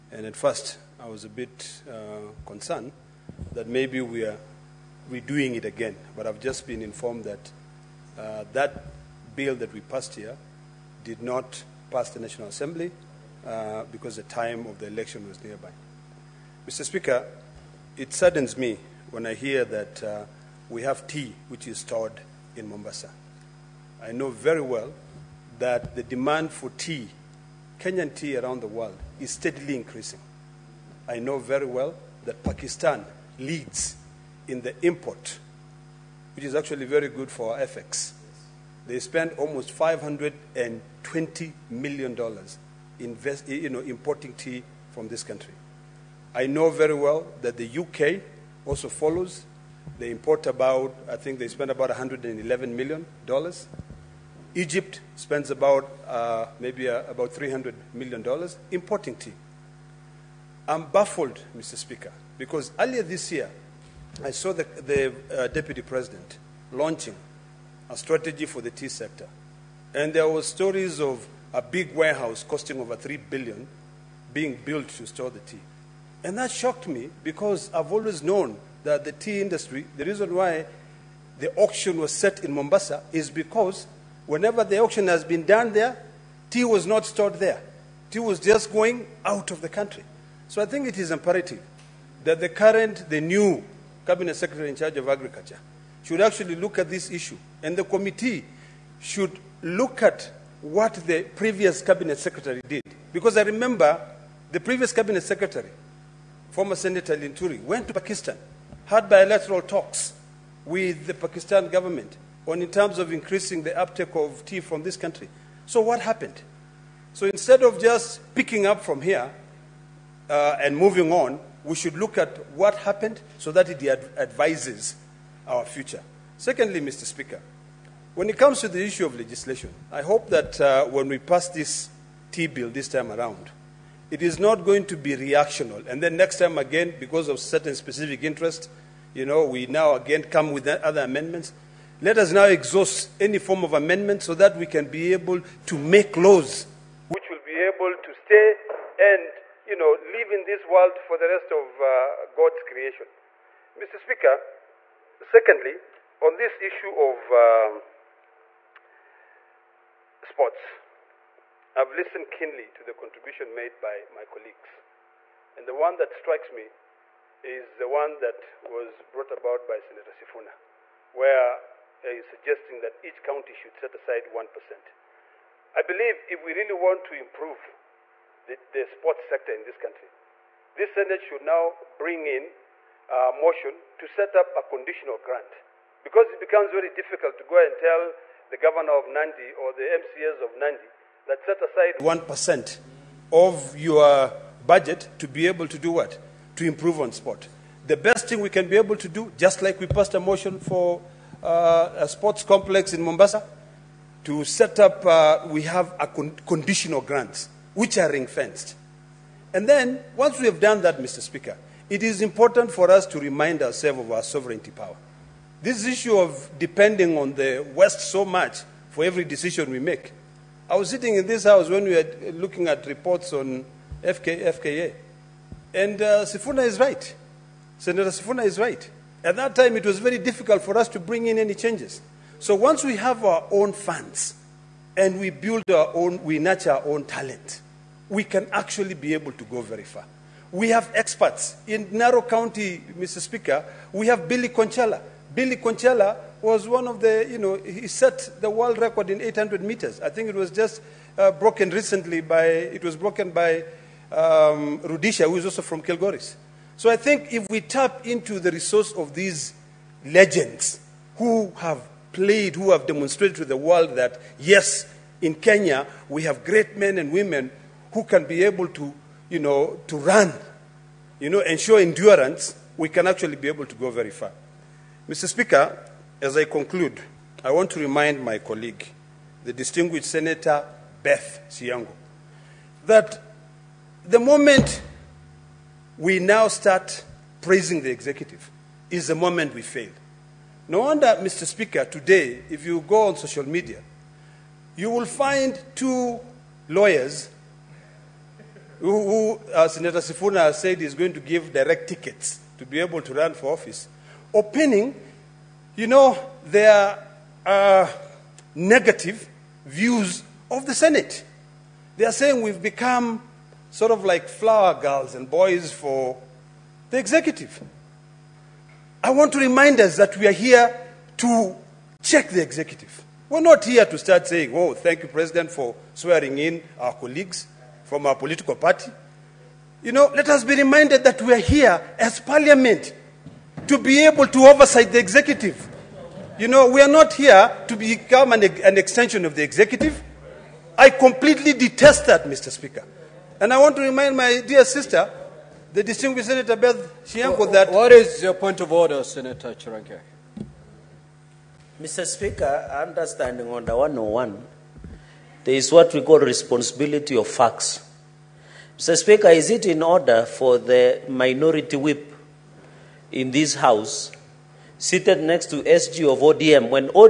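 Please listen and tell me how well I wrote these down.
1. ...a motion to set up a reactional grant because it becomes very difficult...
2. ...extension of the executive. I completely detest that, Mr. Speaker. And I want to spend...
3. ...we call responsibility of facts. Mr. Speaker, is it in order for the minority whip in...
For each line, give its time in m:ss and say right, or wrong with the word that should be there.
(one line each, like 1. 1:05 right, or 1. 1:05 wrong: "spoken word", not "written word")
1. 3:03 wrong: "conditional", not "reactional"
2. 5:38 wrong: "remind", not "spend"
3. 5:55 right.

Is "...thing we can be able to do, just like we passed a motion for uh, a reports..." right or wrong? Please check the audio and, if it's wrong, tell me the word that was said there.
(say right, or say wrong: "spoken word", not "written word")
wrong: "sports", not "reports".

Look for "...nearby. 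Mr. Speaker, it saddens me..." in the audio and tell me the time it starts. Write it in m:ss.
0:15.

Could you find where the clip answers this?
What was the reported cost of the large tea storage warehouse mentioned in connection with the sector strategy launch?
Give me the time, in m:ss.
1:12.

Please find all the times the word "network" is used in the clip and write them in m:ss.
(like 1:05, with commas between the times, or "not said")
not said.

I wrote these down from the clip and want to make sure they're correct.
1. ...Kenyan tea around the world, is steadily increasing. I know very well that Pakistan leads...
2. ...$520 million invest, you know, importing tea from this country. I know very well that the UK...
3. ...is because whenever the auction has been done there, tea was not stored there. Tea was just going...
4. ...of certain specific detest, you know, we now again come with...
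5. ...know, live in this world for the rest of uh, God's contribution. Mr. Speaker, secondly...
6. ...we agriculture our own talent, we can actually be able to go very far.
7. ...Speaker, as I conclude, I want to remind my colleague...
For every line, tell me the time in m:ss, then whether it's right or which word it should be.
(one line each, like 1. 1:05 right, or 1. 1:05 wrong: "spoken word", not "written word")
1. 0:27 right
2. 0:39 right
3. 1:23 right
4. 2:17 wrong: "interest", not "detest"
5. 2:29 wrong: "creation", not "contribution"
6. 3:56 wrong: "nurture", not "agriculture"
7. 4:35 right.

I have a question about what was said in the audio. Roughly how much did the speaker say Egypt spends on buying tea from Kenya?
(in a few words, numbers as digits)
$300 million.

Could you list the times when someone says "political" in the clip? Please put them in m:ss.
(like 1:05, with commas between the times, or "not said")
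5:28.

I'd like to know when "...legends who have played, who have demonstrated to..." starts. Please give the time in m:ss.
4:20.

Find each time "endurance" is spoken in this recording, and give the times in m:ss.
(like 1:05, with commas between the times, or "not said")
4:31.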